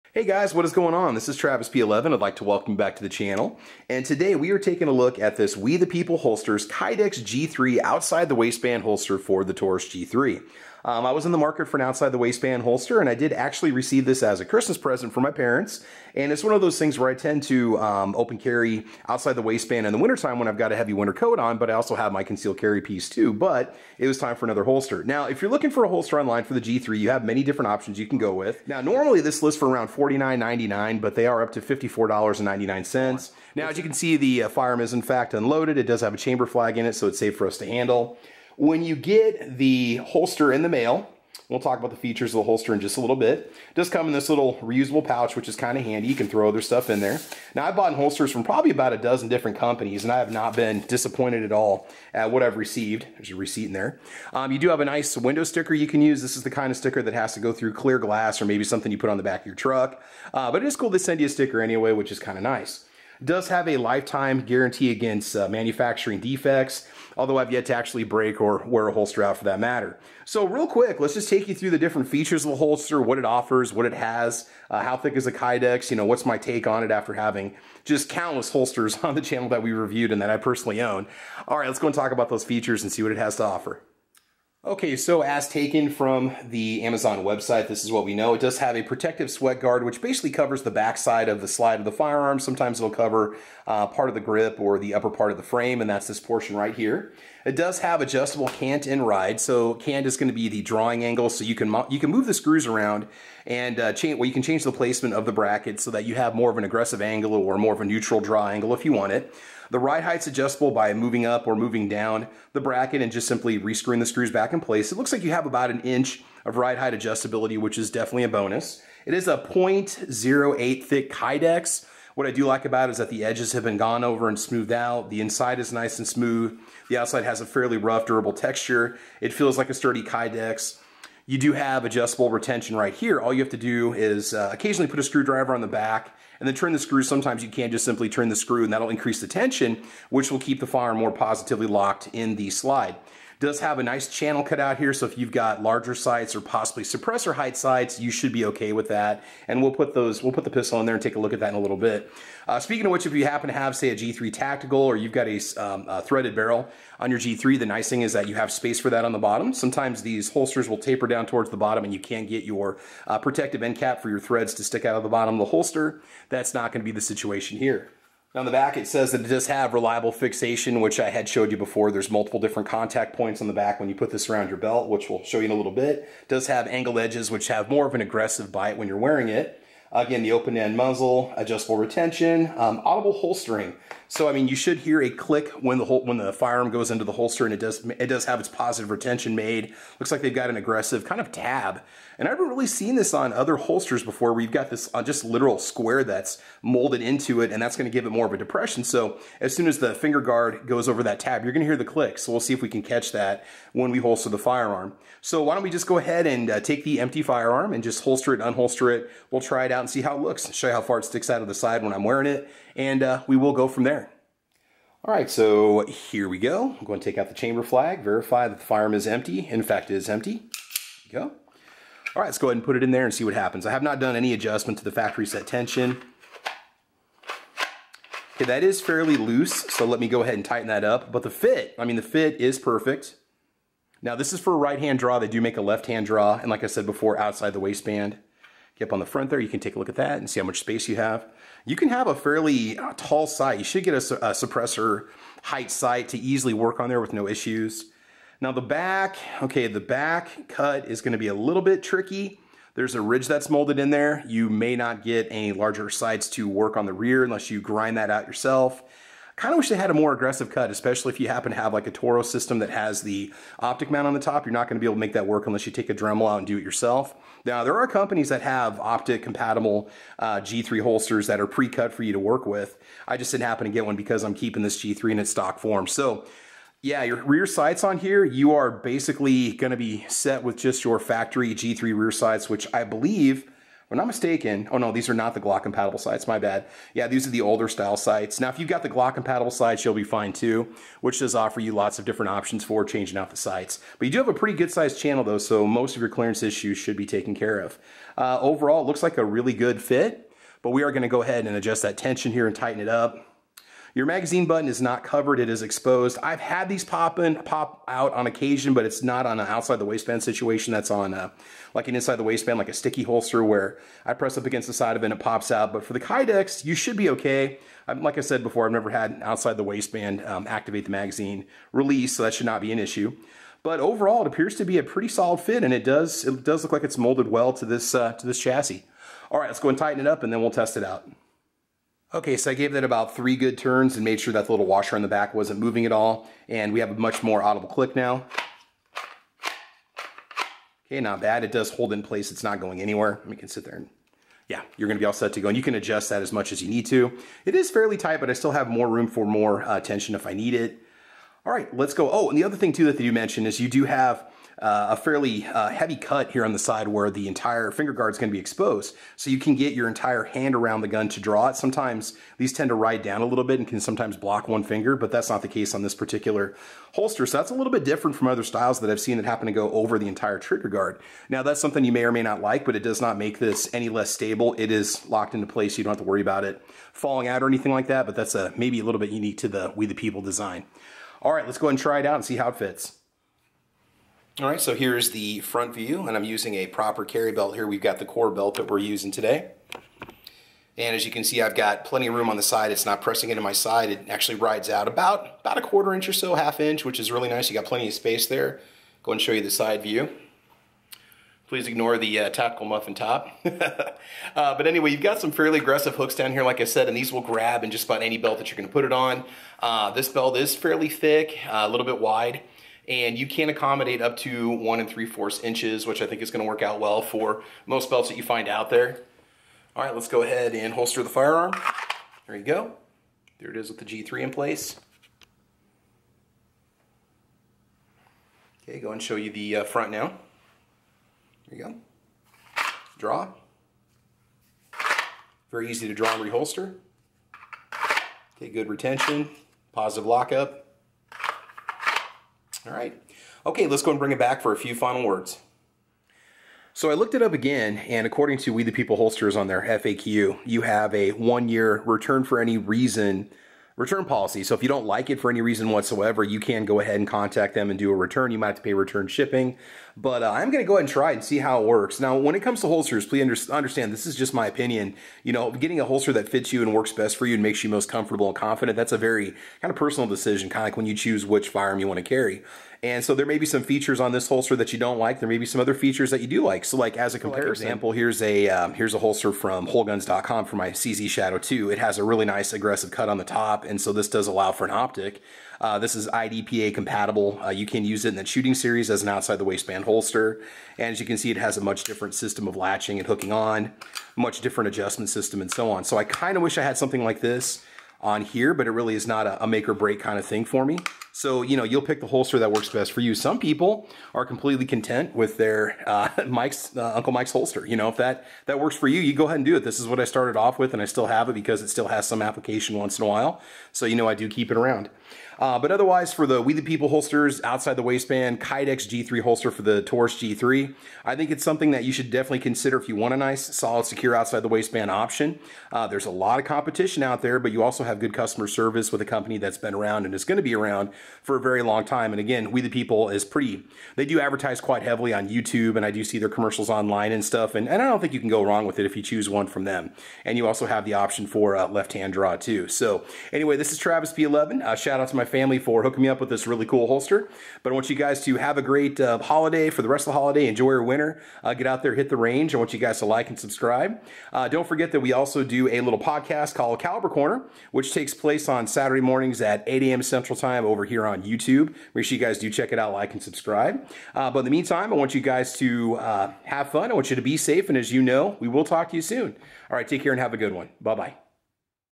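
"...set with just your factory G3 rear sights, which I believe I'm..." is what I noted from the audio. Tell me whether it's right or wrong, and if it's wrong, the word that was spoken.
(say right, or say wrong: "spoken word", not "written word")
right.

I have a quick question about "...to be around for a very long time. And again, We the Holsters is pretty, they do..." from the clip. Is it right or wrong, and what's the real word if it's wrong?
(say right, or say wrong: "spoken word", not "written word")
wrong: "People", not "Holsters".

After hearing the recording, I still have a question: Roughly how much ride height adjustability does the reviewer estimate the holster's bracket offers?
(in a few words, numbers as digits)
about an inch.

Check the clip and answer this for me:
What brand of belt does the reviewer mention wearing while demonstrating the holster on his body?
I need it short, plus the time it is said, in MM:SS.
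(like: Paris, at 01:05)
Core, at 06:28.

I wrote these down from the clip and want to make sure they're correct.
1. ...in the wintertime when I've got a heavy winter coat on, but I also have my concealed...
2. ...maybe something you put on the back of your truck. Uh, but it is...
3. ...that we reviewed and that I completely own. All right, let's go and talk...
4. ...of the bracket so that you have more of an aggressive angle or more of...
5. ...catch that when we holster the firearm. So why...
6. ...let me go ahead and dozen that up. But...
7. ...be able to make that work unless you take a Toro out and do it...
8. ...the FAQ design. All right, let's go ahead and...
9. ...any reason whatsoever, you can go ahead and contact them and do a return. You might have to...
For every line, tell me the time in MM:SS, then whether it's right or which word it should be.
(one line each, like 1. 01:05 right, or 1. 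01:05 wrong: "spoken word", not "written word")
1. 00:19 right
2. 00:58 right
3. 01:19 wrong: "personally", not "completely"
4. 01:45 right
5. 03:22 right
6. 03:49 wrong: "tighten", not "dozen"
7. 04:24 wrong: "Dremel", not "Toro"
8. 06:19 wrong: "People", not "FAQ"
9. 07:35 right.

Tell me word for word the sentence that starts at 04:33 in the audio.
I just didn't happen to get one because I'm keeping this G3 in its stock form.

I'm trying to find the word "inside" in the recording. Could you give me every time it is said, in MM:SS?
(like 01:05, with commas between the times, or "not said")
02:05, 05:11.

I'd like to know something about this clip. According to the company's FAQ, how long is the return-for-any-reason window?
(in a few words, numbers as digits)
one year.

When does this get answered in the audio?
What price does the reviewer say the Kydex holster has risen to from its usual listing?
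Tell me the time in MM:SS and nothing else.
00:31.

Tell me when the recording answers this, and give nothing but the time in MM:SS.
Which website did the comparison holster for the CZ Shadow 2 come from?
07:59.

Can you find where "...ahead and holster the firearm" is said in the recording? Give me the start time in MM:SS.
07:00.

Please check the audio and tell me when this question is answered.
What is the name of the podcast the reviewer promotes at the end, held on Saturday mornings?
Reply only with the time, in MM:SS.
09:16.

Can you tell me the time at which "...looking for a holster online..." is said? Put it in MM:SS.
00:25.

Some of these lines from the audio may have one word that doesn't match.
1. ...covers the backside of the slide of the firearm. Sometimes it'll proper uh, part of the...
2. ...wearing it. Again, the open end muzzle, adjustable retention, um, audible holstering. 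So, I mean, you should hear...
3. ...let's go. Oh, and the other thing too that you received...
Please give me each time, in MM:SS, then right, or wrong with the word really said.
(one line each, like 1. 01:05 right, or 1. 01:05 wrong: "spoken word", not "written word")
1. 01:30 wrong: "cover", not "proper"
2. 02:58 right
3. 05:51 wrong: "mentioned", not "received".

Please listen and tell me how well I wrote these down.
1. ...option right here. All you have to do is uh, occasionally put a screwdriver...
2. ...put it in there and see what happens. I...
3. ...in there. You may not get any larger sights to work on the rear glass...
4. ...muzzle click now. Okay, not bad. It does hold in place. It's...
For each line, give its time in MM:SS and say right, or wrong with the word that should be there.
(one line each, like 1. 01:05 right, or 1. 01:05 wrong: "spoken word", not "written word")
1. 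02:12 wrong: "retention", not "option"
2. 03:42 right
3. 04:13 wrong: "unless", not "glass"
4. 05:37 wrong: "audible", not "muzzle".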